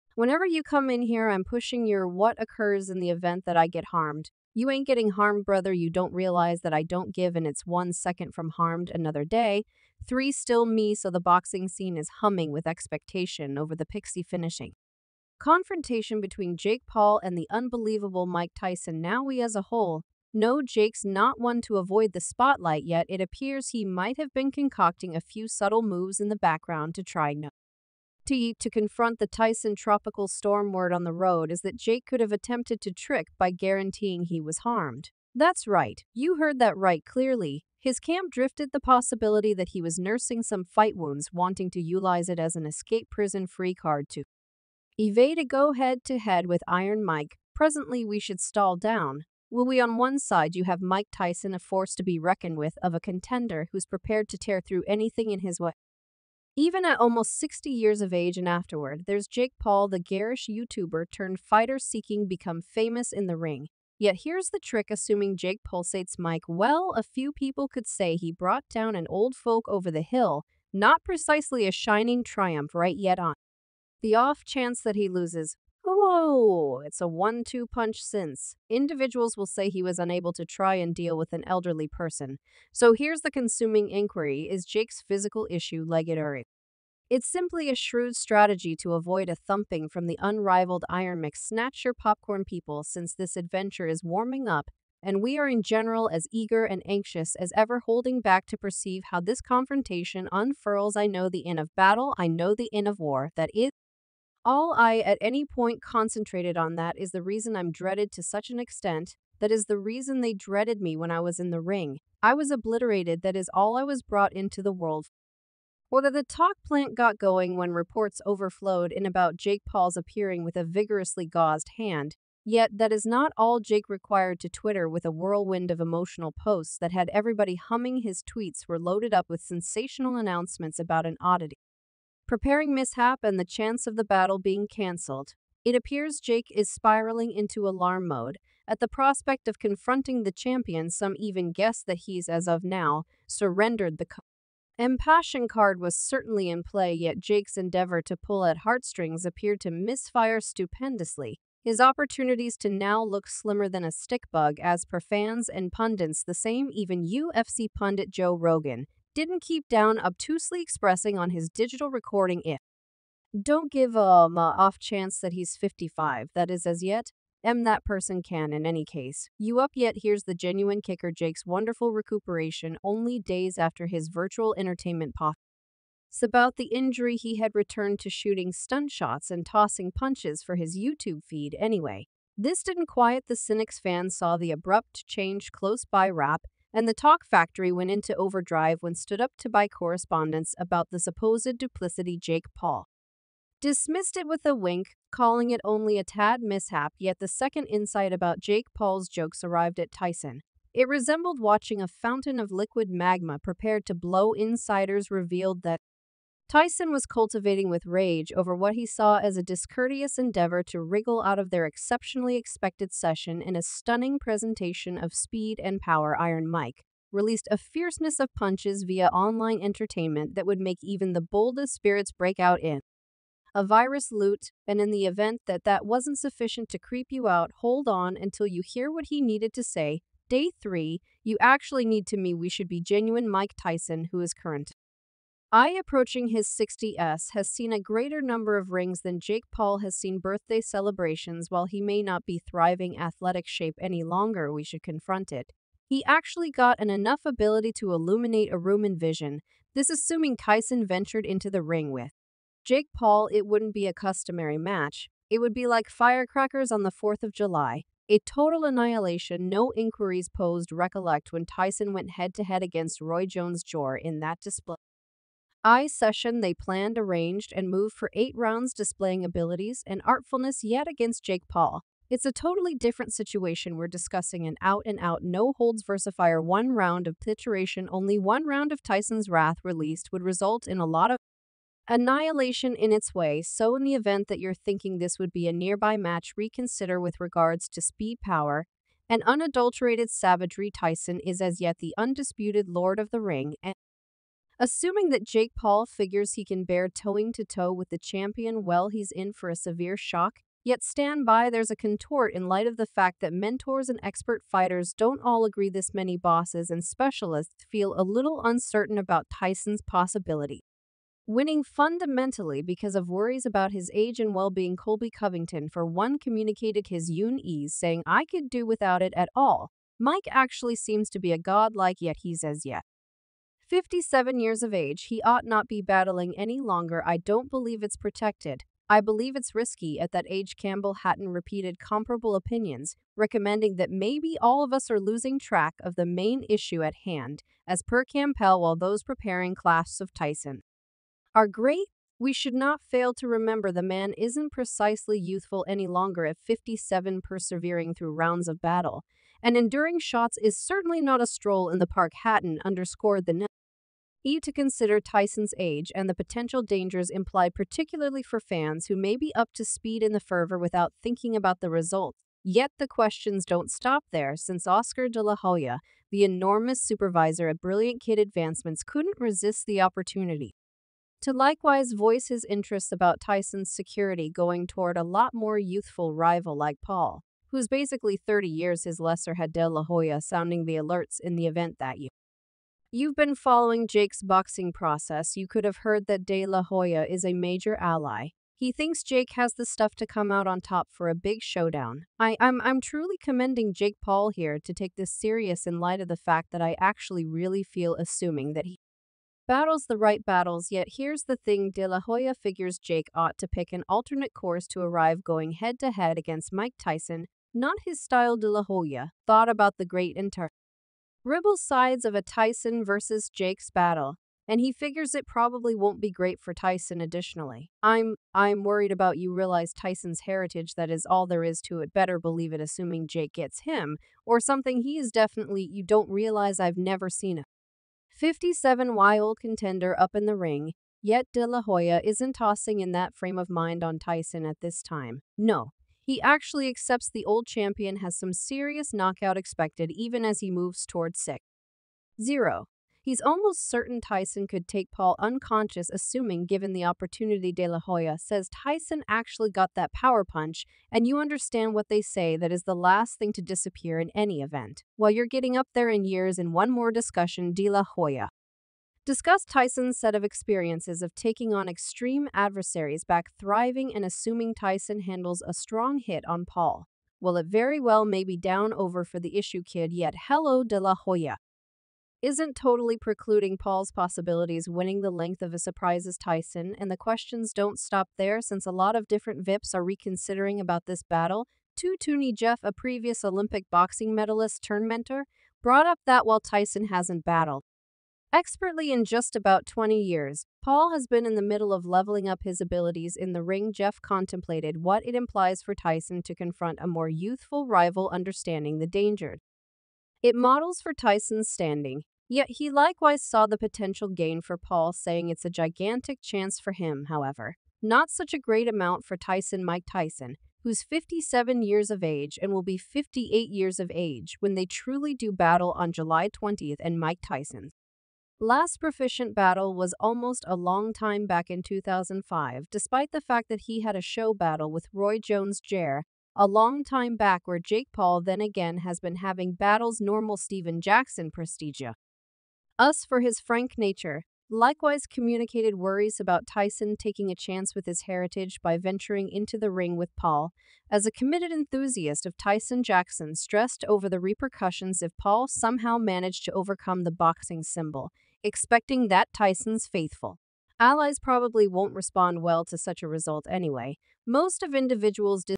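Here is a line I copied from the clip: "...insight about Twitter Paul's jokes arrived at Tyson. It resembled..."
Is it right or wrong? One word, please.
wrong.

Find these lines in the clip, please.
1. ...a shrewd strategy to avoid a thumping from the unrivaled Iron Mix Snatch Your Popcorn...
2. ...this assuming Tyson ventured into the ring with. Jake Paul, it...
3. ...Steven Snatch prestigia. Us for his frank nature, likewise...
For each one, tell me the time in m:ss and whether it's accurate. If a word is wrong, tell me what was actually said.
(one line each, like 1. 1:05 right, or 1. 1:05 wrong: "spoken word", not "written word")
1. 1:27 right
2. 4:09 right
3. 8:50 wrong: "Jackson", not "Snatch".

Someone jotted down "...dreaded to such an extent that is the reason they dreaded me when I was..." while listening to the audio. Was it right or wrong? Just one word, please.
right.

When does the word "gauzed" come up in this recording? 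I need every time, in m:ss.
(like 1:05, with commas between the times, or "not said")
2:01.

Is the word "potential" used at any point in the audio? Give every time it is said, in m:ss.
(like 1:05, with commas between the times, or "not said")
5:56, 8:23.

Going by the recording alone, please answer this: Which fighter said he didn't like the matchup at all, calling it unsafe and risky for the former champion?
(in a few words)
Colby Covington.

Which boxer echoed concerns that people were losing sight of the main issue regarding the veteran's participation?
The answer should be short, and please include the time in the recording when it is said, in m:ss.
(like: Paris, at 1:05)
Campbell Hatton, at 5:30.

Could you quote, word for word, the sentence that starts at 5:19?
Mike actually seems to be a god like, yet he's as yet.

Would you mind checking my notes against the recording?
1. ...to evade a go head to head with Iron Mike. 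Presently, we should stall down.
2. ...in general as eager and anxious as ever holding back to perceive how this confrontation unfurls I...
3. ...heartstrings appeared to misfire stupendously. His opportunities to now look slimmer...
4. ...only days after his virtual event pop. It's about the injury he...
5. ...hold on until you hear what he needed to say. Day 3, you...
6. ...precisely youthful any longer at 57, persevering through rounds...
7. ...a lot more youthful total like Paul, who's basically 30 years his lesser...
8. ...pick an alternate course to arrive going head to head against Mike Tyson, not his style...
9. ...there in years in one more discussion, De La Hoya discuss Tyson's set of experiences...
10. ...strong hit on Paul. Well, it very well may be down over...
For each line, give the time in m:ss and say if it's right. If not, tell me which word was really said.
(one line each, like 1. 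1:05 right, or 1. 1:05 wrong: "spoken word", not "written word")
1. 0:44 right
2. 1:35 right
3. 2:28 right
4. 2:52 wrong: "entertainment", not "event"
5. 3:47 right
6. 5:44 right
7. 6:14 wrong: "rival", not "total"
8. 6:43 right
9. 7:35 right
10. 7:45 right.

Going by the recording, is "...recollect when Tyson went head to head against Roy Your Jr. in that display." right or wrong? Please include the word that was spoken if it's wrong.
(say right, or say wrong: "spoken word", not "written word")
wrong: "Jones", not "Your".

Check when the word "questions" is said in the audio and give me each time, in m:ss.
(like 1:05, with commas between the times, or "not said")
6:02, 7:56.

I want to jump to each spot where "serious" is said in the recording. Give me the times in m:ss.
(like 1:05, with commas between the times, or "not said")
6:35, 7:18.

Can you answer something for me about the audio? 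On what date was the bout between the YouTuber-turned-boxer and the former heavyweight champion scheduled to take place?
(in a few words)
July 20.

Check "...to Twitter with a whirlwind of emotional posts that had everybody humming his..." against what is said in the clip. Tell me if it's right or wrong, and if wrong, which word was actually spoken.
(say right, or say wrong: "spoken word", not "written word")
right.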